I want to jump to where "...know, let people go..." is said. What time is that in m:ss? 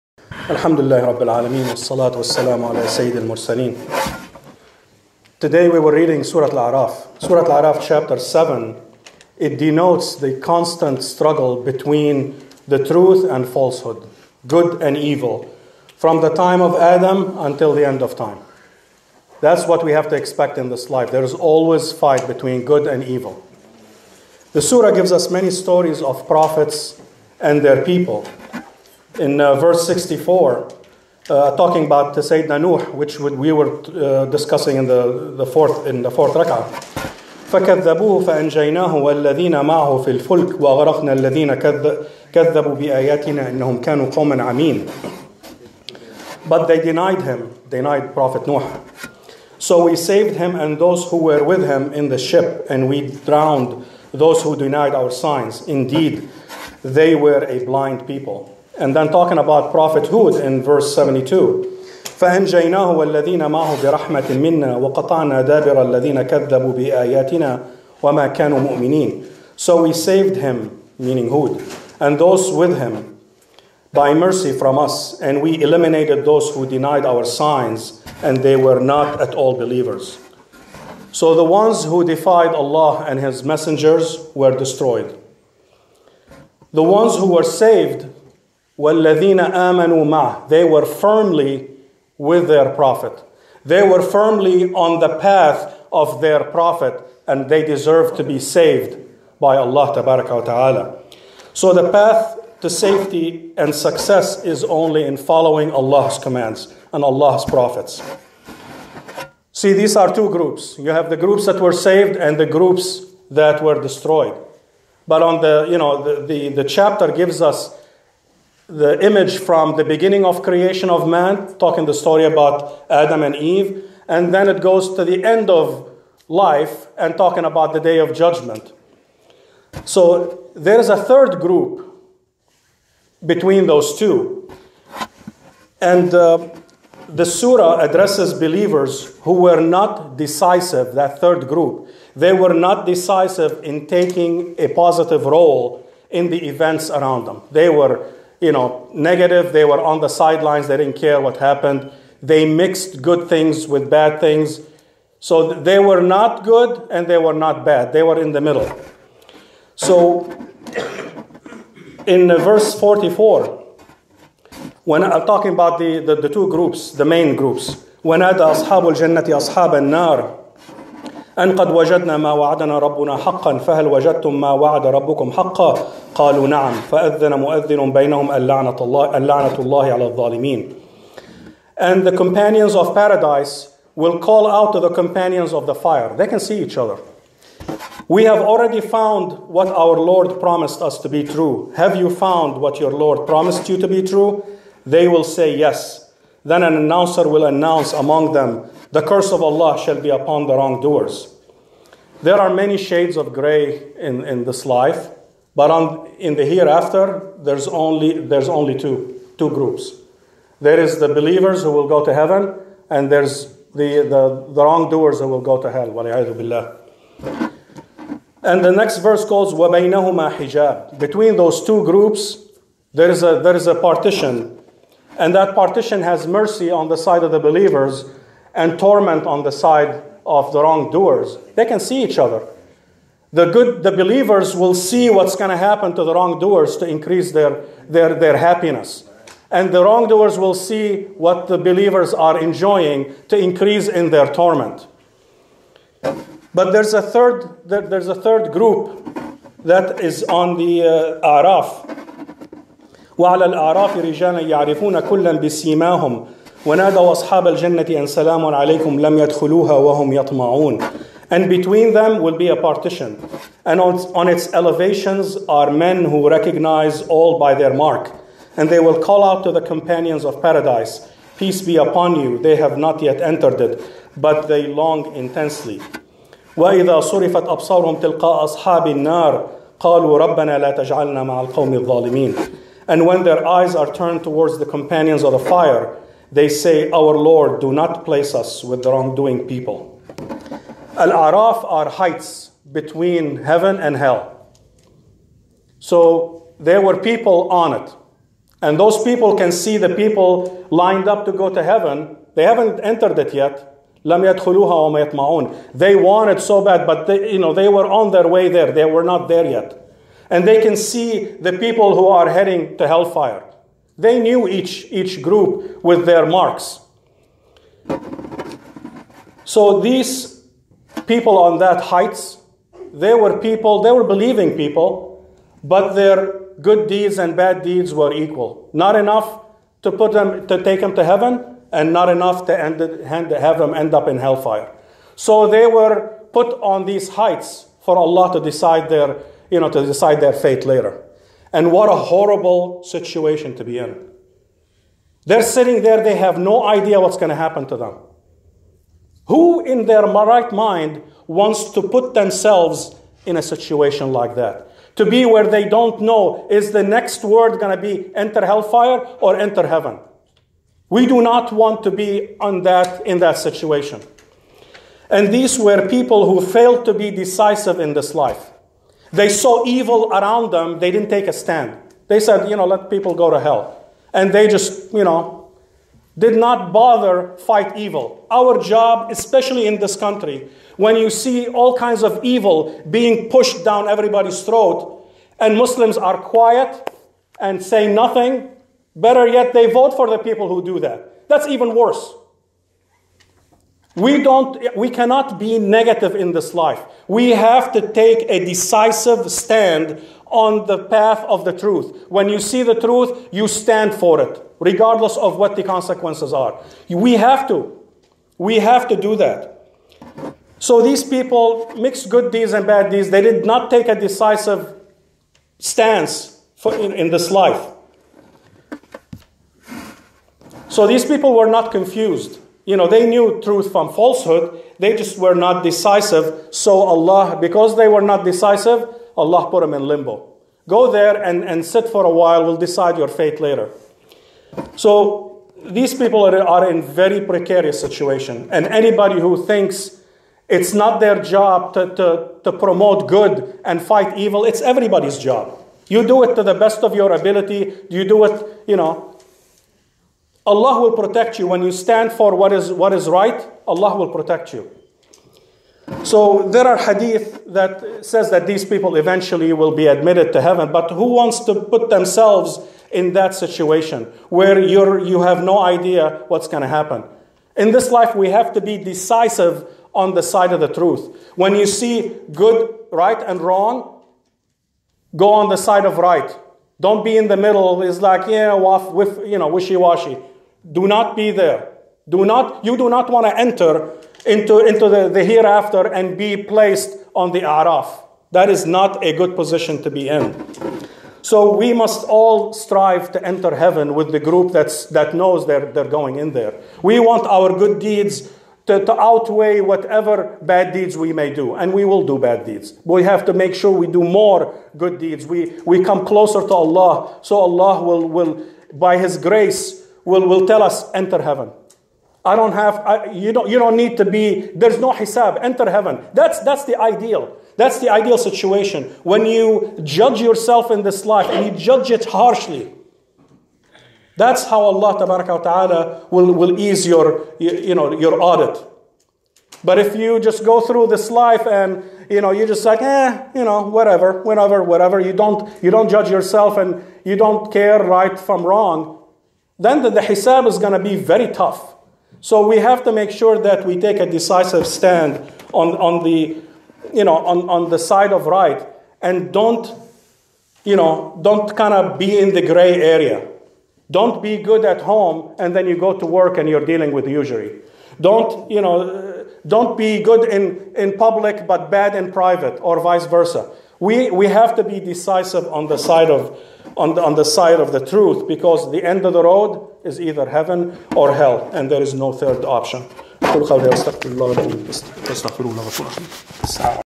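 6:12.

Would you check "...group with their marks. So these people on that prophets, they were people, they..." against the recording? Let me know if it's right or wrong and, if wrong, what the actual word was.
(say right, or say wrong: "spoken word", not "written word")
wrong: "heights", not "prophets".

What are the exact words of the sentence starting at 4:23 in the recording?
And on, on its elevations are men who recognize all by their mark.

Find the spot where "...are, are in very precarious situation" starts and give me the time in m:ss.
7:16.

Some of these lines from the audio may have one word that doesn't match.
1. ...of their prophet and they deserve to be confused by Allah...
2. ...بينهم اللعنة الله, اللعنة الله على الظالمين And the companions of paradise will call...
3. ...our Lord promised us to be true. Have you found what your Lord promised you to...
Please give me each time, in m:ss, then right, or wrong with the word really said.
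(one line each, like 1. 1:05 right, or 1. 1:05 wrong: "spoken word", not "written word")
1. 1:35 wrong: "saved", not "confused"
2. 2:57 right
3. 3:09 right.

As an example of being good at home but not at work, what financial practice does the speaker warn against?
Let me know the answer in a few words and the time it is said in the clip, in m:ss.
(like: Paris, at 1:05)
usury, at 9:17.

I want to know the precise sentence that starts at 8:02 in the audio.
Do not, you do not want to enter into, into the, the hereafter and be placed on the araf.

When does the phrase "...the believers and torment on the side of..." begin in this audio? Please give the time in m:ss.
3:47.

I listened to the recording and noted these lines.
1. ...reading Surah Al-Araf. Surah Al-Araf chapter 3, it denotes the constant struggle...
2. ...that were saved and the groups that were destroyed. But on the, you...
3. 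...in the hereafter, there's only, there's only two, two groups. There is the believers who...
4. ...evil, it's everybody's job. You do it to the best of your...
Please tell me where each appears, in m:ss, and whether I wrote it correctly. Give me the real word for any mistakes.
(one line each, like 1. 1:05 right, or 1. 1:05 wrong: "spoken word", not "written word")
1. 0:05 wrong: "7", not "3"
2. 1:51 right
3. 3:26 right
4. 7:24 right.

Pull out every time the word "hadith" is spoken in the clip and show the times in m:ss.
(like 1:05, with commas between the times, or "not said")
7:36.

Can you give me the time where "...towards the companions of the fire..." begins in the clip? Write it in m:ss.
4:44.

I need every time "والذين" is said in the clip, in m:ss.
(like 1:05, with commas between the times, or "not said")
0:38, 1:02, 1:28.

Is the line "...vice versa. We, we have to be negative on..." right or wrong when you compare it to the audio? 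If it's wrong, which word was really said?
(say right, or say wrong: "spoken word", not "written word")
wrong: "decisive", not "negative".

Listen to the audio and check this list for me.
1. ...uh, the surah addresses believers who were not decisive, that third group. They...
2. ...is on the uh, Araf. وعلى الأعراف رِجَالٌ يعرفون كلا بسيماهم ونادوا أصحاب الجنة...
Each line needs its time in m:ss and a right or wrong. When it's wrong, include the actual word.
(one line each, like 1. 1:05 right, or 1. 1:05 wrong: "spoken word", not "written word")
1. 2:16 right
2. 4:10 right.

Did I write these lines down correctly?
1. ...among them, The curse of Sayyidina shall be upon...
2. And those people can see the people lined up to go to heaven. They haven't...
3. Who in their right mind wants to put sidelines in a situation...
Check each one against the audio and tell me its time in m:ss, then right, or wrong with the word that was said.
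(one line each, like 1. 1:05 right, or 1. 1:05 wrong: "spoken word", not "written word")
1. 3:17 wrong: "Allah", not "Sayyidina"
2. 4:58 right
3. 5:49 wrong: "themselves", not "sidelines".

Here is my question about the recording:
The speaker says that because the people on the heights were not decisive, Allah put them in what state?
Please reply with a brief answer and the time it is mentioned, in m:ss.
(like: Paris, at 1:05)
limbo, at 7:09.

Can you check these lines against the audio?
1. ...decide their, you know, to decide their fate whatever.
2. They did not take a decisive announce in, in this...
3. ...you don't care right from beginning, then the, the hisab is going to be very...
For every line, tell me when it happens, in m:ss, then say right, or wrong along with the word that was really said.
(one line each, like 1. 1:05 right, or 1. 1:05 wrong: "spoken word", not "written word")
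1. 5:38 wrong: "later", not "whatever"
2. 6:53 wrong: "stance", not "announce"
3. 8:57 wrong: "wrong", not "beginning".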